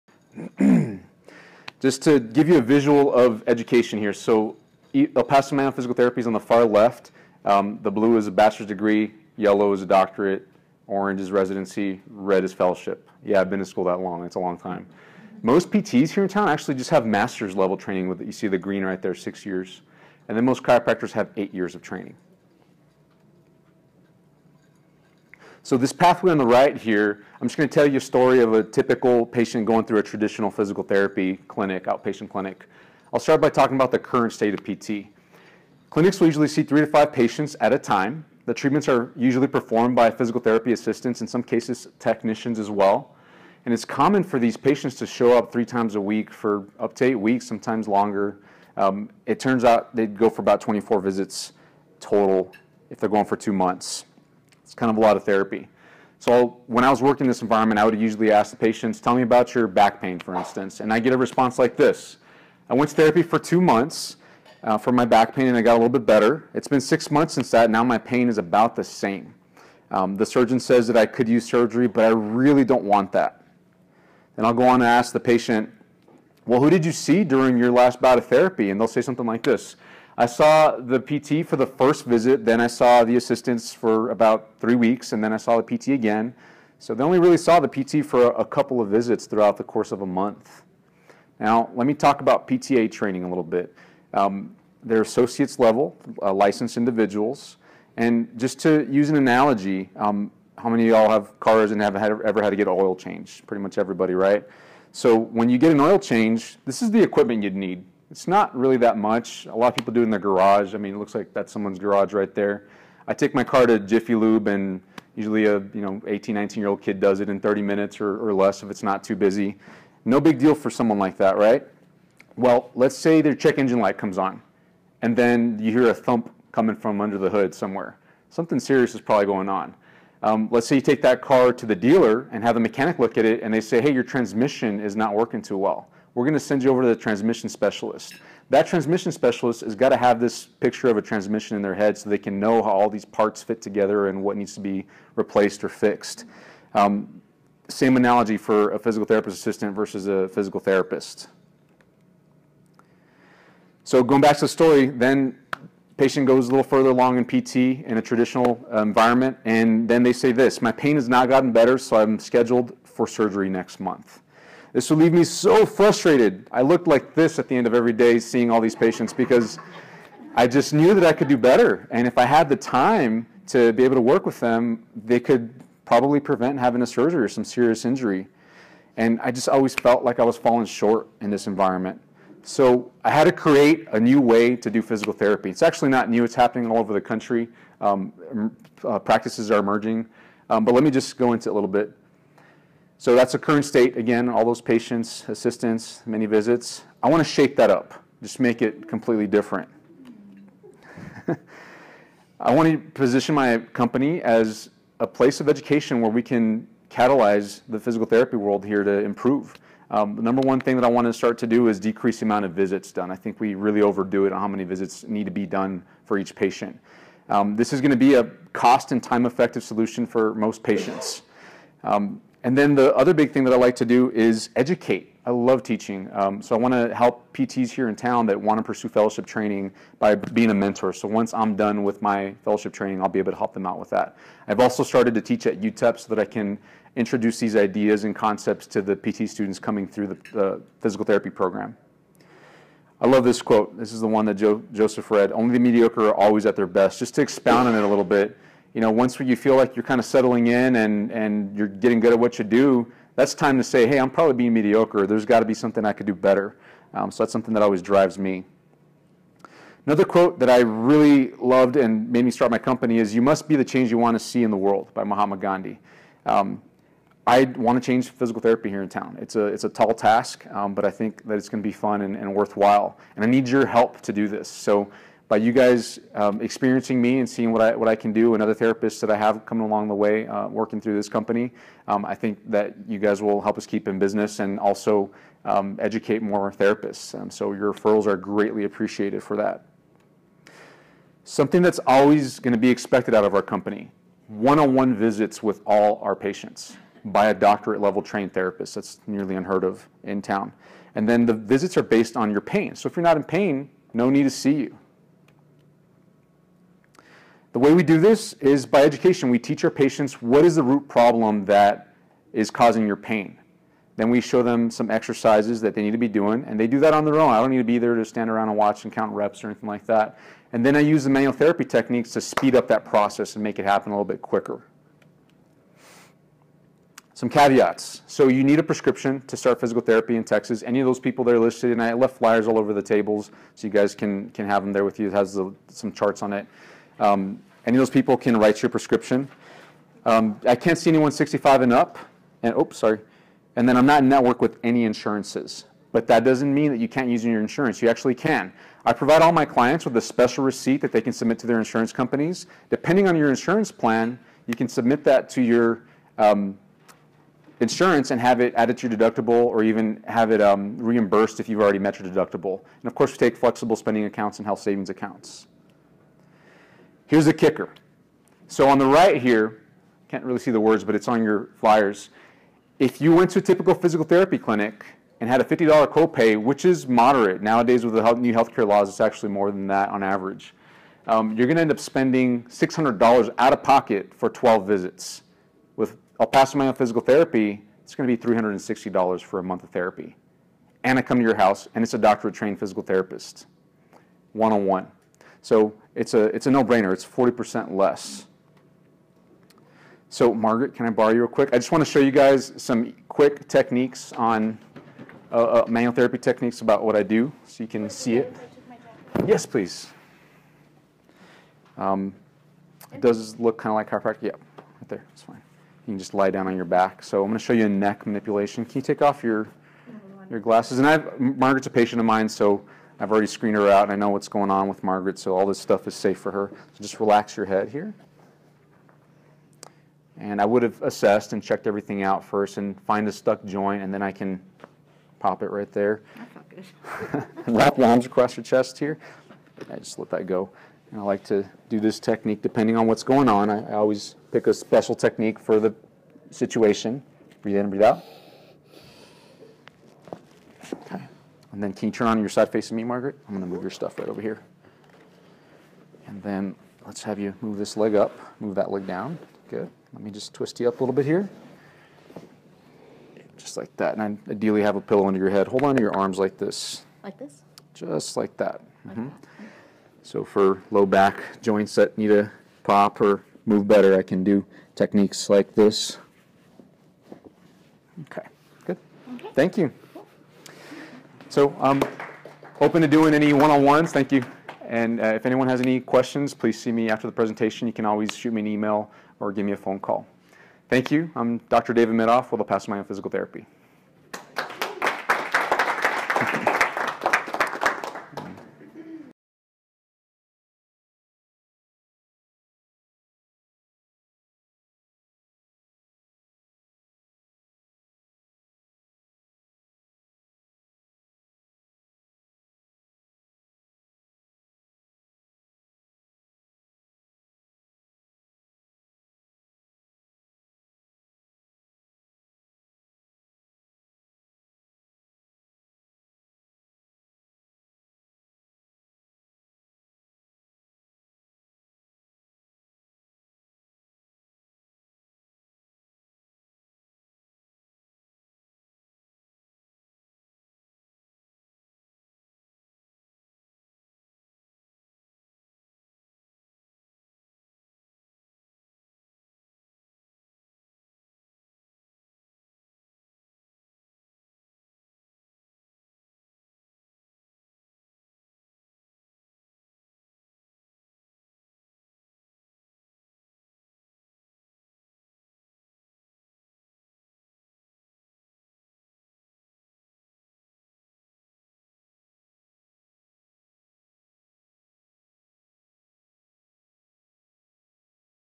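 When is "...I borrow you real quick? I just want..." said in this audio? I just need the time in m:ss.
6:40.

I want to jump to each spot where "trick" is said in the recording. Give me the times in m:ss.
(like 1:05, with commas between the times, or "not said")
not said.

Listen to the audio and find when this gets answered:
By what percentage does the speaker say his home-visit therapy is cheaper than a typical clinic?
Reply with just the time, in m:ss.
6:37.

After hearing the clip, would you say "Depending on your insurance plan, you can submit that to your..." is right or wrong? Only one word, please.
right.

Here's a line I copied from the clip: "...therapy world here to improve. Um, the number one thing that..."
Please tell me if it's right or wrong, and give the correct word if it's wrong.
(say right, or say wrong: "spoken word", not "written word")
right.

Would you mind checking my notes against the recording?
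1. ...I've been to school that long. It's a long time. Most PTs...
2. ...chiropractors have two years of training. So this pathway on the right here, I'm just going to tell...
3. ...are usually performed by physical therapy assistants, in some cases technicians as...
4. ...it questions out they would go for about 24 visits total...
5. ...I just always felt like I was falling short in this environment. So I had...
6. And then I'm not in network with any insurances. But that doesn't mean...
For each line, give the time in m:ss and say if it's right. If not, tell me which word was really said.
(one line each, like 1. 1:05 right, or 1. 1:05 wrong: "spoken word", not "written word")
1. 0:13 right
2. 0:20 wrong: "eight", not "two"
3. 0:38 right
4. 0:49 wrong: "turns", not "questions"
5. 2:59 right
6. 5:43 right.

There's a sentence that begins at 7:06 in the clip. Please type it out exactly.
So just relax your head here.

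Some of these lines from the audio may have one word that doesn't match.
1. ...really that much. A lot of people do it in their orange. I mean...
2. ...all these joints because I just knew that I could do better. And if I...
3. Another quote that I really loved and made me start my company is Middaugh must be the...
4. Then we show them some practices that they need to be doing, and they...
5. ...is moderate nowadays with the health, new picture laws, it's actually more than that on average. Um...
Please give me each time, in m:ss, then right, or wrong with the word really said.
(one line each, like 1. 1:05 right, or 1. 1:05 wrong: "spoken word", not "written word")
1. 1:48 wrong: "garage", not "orange"
2. 2:48 wrong: "patients", not "joints"
3. 4:19 wrong: "You", not "Middaugh"
4. 5:13 wrong: "exercises", not "practices"
5. 6:16 wrong: "healthcare", not "picture".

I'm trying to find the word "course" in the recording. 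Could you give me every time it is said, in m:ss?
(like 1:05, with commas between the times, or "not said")
1:29, 6:02.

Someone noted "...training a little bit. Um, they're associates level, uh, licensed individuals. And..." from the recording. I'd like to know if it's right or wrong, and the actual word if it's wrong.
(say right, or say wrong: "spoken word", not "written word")
right.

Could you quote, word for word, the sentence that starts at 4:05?
Only the mediocre are always at their best.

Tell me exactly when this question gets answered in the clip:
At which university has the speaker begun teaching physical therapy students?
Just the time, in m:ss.
3:55.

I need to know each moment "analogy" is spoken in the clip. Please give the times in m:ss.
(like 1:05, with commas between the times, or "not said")
1:39, 2:27.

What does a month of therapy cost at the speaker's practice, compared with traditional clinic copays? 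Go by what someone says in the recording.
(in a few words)
$360.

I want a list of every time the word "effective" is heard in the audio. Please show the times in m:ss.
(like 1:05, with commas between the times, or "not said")
3:39.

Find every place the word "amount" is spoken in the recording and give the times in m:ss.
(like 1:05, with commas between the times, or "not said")
3:32.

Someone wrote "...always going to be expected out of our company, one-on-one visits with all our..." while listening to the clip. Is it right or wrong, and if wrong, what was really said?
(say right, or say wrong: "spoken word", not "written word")
right.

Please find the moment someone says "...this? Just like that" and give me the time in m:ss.
7:47.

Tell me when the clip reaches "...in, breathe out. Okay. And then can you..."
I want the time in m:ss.
7:27.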